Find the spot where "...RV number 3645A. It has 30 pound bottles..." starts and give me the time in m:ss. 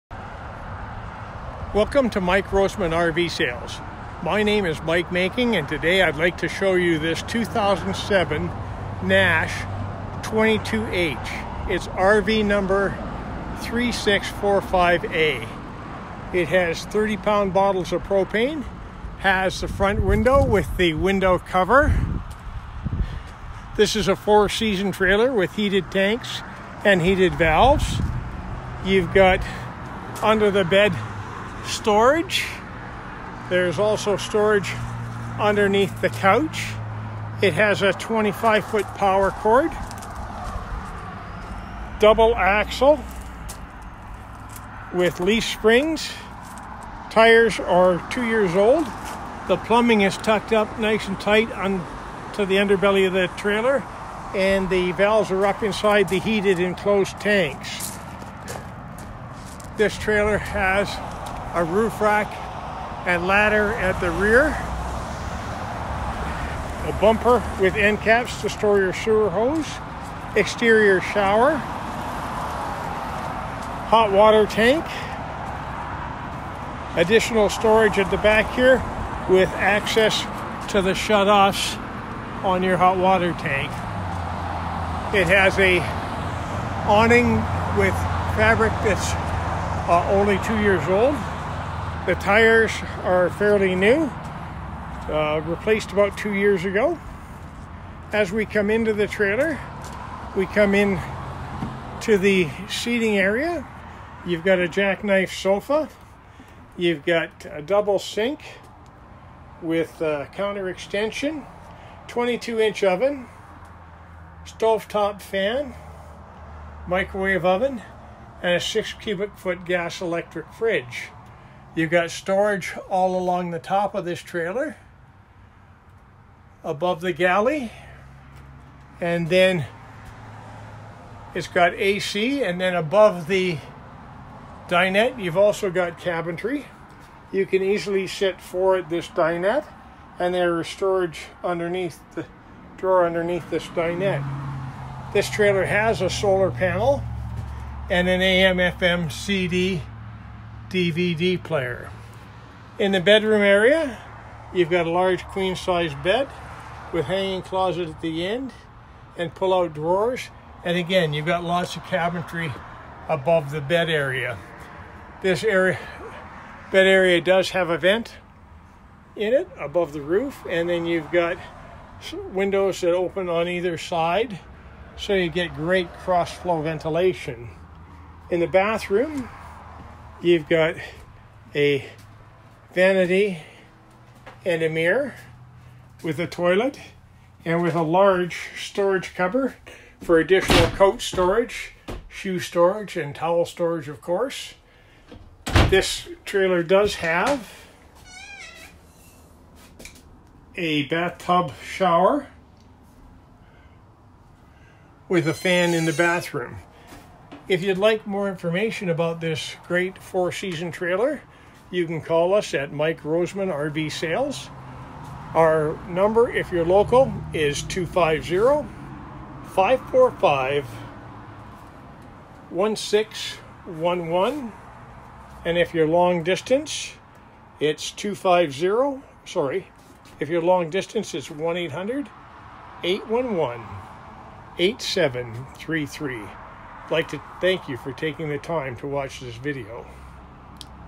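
0:11.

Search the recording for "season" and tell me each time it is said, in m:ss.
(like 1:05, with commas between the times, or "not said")
0:24, 3:30.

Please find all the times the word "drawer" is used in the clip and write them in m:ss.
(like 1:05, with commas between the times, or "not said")
2:22, 2:39.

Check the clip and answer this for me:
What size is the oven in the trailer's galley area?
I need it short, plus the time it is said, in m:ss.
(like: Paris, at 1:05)
22 inch, at 1:52.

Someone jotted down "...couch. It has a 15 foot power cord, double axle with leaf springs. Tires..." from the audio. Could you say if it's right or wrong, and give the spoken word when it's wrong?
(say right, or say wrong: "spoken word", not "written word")
wrong: "25", not "15".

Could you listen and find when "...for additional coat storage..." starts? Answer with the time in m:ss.
3:09.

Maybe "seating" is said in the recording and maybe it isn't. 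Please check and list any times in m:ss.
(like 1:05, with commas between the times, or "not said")
1:42.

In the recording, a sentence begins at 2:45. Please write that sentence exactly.
This area, bed area does have a vent in it above the roof.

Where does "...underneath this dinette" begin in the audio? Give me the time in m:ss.
2:23.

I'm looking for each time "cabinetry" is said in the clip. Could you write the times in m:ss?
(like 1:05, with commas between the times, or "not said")
2:15, 2:41.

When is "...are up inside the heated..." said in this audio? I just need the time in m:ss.
0:55.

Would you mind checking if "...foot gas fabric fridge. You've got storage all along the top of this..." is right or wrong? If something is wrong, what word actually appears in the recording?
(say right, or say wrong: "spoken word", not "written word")
wrong: "electric", not "fabric".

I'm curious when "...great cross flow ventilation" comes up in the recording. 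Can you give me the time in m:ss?
2:55.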